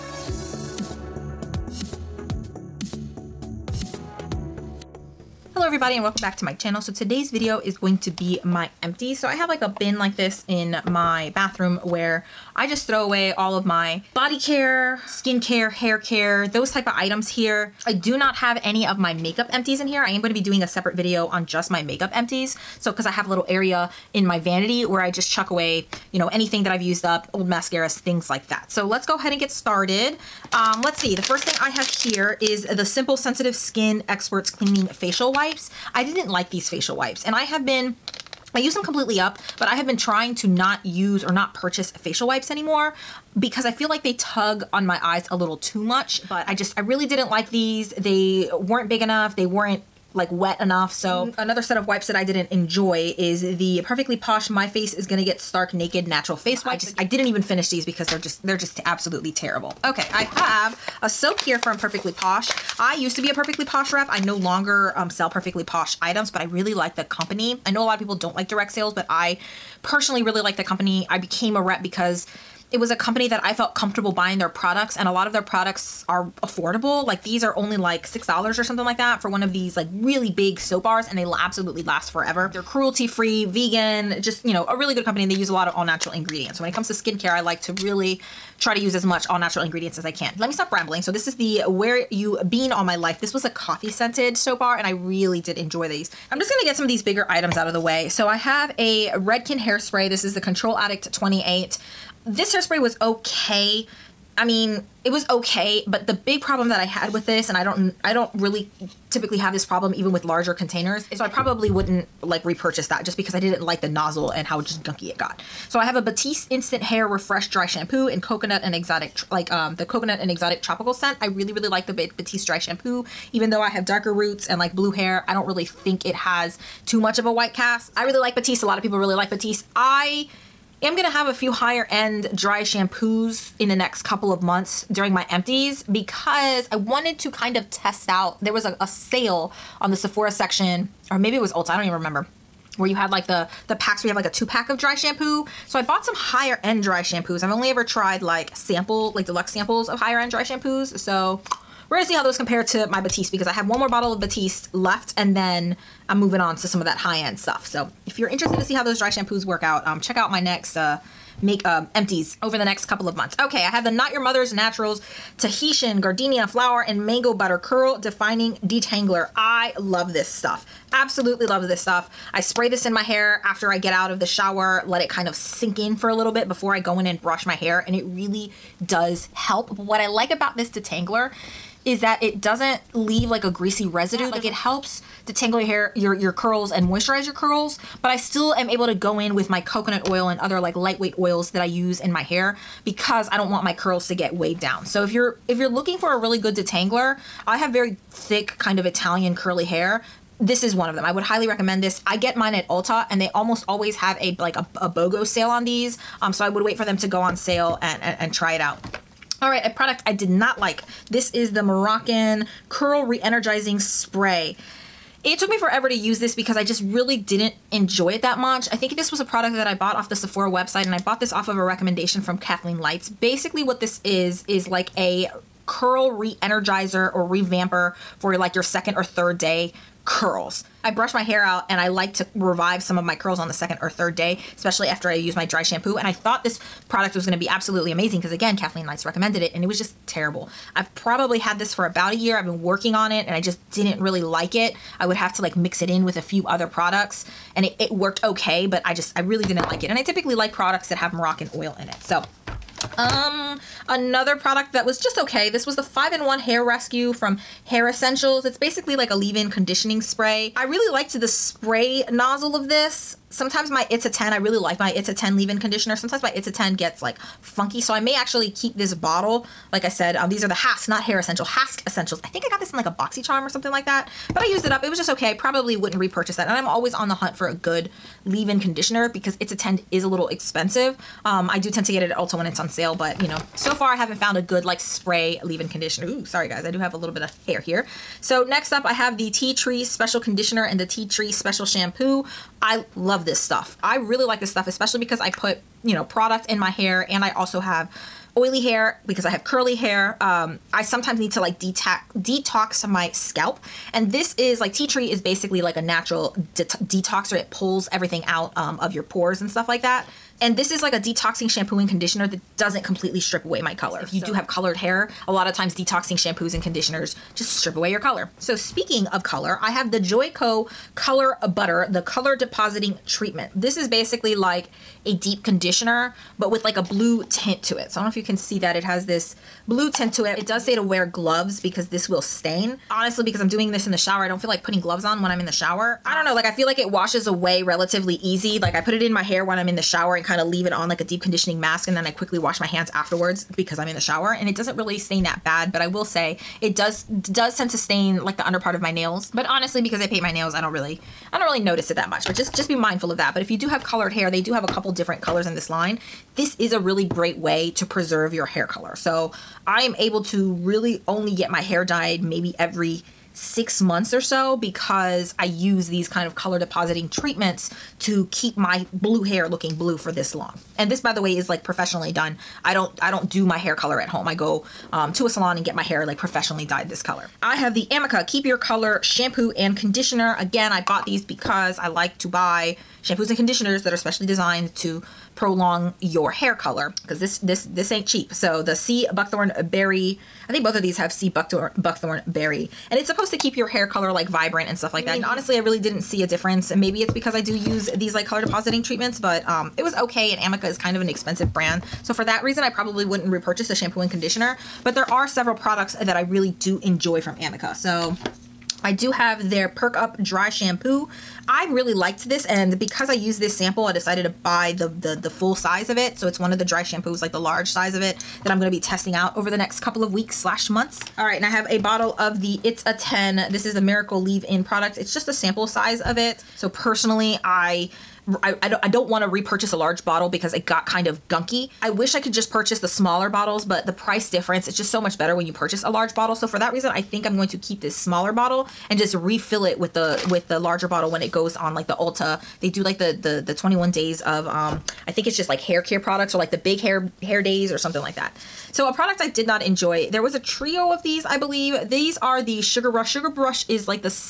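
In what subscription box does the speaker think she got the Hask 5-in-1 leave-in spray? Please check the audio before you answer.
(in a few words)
BoxyCharm.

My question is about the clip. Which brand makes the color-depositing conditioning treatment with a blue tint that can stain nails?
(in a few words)
Joico.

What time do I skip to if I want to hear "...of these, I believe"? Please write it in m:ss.
7:30.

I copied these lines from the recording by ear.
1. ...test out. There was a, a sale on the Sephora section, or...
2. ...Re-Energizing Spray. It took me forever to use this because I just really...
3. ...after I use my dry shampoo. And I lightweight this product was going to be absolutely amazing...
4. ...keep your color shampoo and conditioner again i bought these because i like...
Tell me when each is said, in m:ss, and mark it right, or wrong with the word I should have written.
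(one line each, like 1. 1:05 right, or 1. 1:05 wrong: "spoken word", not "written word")
1. 2:17 right
2. 3:33 right
3. 3:54 wrong: "thought", not "lightweight"
4. 6:18 right.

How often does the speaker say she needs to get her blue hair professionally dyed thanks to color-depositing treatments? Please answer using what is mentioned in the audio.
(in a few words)
Every 6 months.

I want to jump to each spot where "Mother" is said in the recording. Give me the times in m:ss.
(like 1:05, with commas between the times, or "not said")
2:44.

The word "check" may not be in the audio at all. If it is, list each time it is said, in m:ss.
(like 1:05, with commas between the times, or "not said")
2:40.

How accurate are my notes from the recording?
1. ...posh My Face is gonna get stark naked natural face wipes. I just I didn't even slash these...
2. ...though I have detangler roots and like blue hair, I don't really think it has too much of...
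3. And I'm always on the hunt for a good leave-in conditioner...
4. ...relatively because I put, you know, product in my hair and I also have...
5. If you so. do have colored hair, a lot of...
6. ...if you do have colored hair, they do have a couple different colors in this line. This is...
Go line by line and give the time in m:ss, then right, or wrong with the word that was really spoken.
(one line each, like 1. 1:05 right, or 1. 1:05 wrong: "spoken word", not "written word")
1. 0:54 wrong: "finish", not "slash"
2. 2:03 wrong: "darker", not "detangler"
3. 4:36 right
4. 4:54 wrong: "especially", not "relatively"
5. 5:14 right
6. 5:53 right.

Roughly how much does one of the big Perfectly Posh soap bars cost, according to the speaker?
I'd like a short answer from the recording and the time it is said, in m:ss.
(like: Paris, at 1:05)
$6, at 1:18.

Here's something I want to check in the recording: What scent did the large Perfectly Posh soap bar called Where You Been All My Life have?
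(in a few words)
Coffee.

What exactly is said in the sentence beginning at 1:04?
I no longer um, sell Perfectly Posh items, but I really like the company.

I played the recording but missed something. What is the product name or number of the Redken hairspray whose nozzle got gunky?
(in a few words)
Control Addict 28.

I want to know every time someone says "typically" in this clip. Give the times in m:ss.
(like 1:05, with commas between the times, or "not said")
1:49, 4:10.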